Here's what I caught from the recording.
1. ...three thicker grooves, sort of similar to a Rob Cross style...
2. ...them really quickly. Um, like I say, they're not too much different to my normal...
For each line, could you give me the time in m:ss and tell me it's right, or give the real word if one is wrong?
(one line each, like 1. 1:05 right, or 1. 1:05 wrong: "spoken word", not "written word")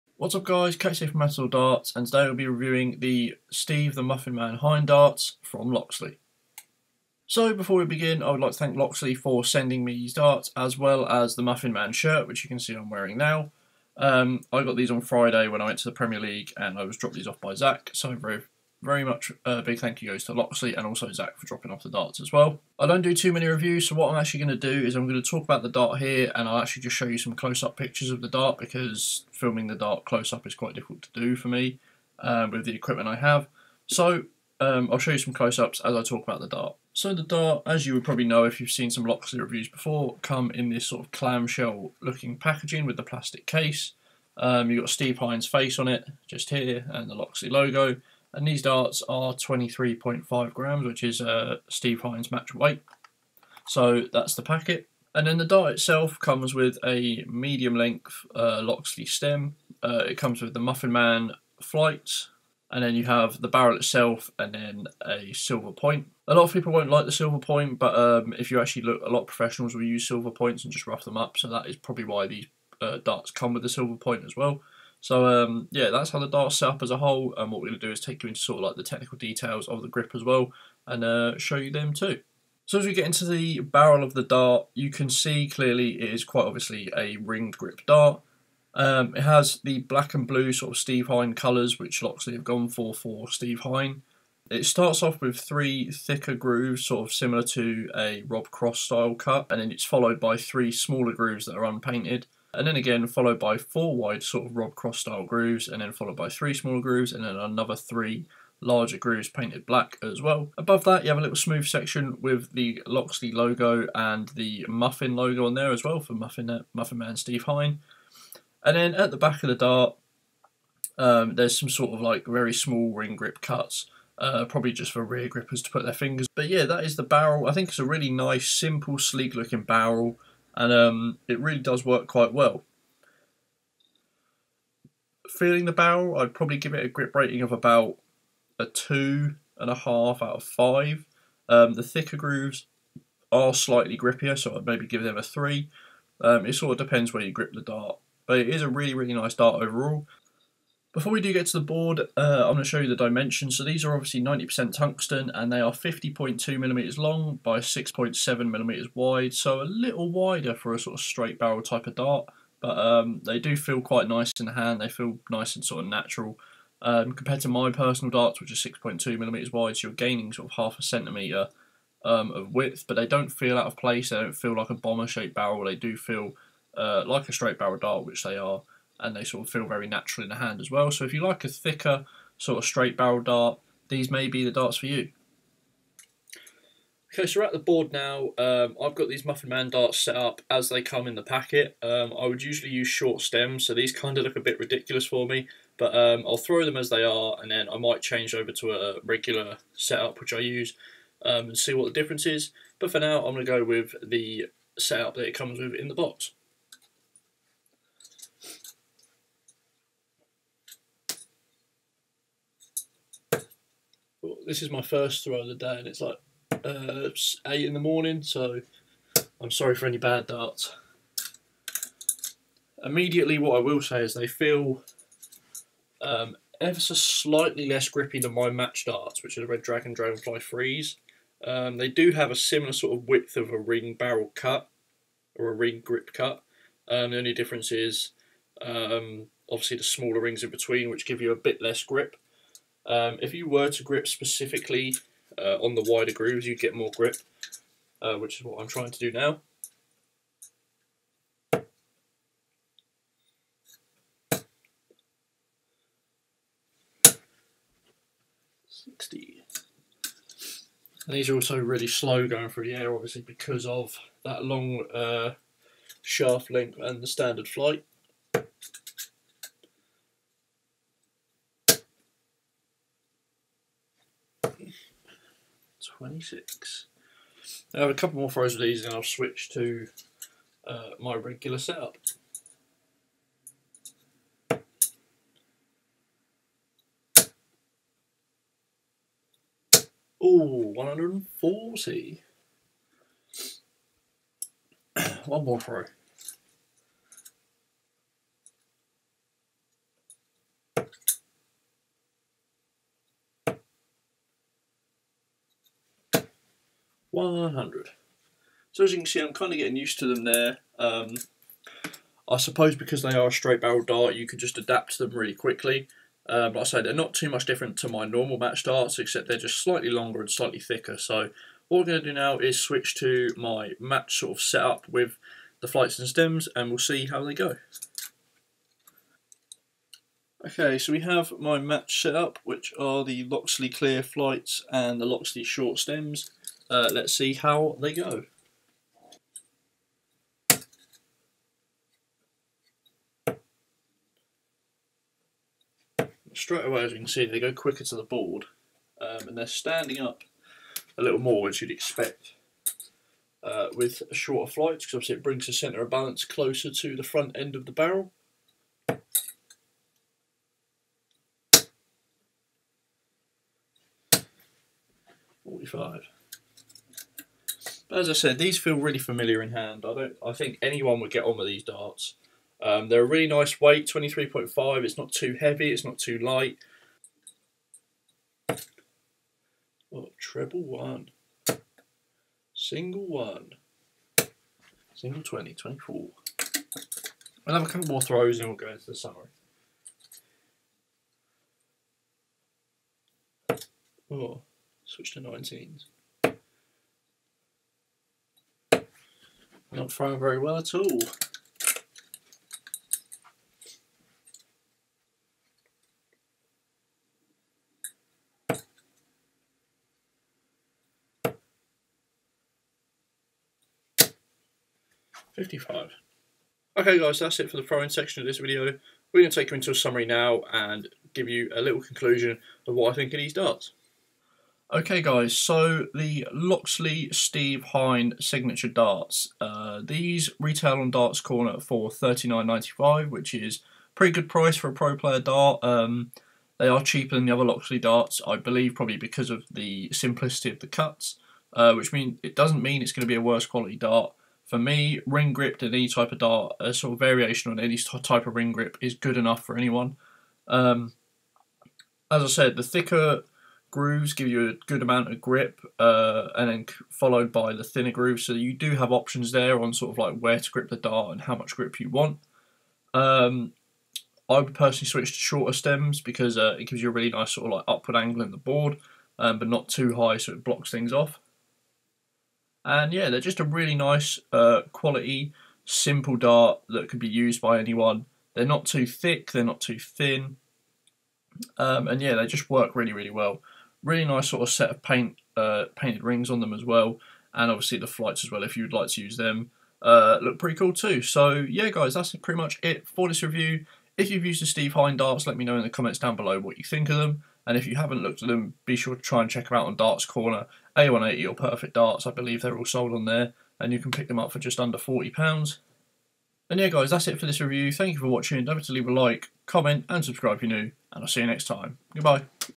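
1. 1:35 right
2. 5:15 right.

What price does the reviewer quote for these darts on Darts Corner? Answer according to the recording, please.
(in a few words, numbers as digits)
$39.95.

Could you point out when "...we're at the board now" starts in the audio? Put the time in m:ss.
3:07.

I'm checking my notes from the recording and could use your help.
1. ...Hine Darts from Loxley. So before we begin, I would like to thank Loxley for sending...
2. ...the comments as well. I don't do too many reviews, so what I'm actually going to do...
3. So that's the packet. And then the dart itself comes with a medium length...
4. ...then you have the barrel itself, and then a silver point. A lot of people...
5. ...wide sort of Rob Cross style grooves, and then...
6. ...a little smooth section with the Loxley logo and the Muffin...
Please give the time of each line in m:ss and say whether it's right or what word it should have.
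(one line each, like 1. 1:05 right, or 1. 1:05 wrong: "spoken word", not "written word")
1. 0:04 right
2. 0:21 wrong: "darts", not "comments"
3. 0:53 right
4. 1:02 right
5. 1:43 right
6. 1:51 right.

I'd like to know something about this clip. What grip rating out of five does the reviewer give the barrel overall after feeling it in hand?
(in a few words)
2.5.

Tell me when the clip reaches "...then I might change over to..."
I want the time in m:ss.
3:17.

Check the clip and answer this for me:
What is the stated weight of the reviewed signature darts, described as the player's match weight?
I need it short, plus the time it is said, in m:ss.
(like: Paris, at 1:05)
23.5 grams, at 0:49.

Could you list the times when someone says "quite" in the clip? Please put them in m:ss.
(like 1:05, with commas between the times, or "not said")
0:30, 1:26, 2:12, 2:43.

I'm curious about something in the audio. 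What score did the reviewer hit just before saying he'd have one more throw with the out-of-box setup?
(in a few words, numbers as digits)
140.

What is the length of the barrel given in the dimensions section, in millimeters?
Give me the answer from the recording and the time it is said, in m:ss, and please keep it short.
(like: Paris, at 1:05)
50.2 mm, at 2:35.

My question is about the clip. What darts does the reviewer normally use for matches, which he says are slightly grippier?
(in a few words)
Red Dragon Dragonfly Freeze.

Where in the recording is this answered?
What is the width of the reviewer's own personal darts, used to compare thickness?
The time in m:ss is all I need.
2:48.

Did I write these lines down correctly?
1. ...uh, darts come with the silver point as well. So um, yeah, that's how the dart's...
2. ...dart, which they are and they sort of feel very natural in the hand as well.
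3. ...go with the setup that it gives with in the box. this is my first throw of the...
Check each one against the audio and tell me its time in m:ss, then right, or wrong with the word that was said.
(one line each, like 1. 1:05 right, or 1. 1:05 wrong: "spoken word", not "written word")
1. 1:12 right
2. 2:57 right
3. 3:23 wrong: "comes", not "gives".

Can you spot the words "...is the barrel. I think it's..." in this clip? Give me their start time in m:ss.
2:06.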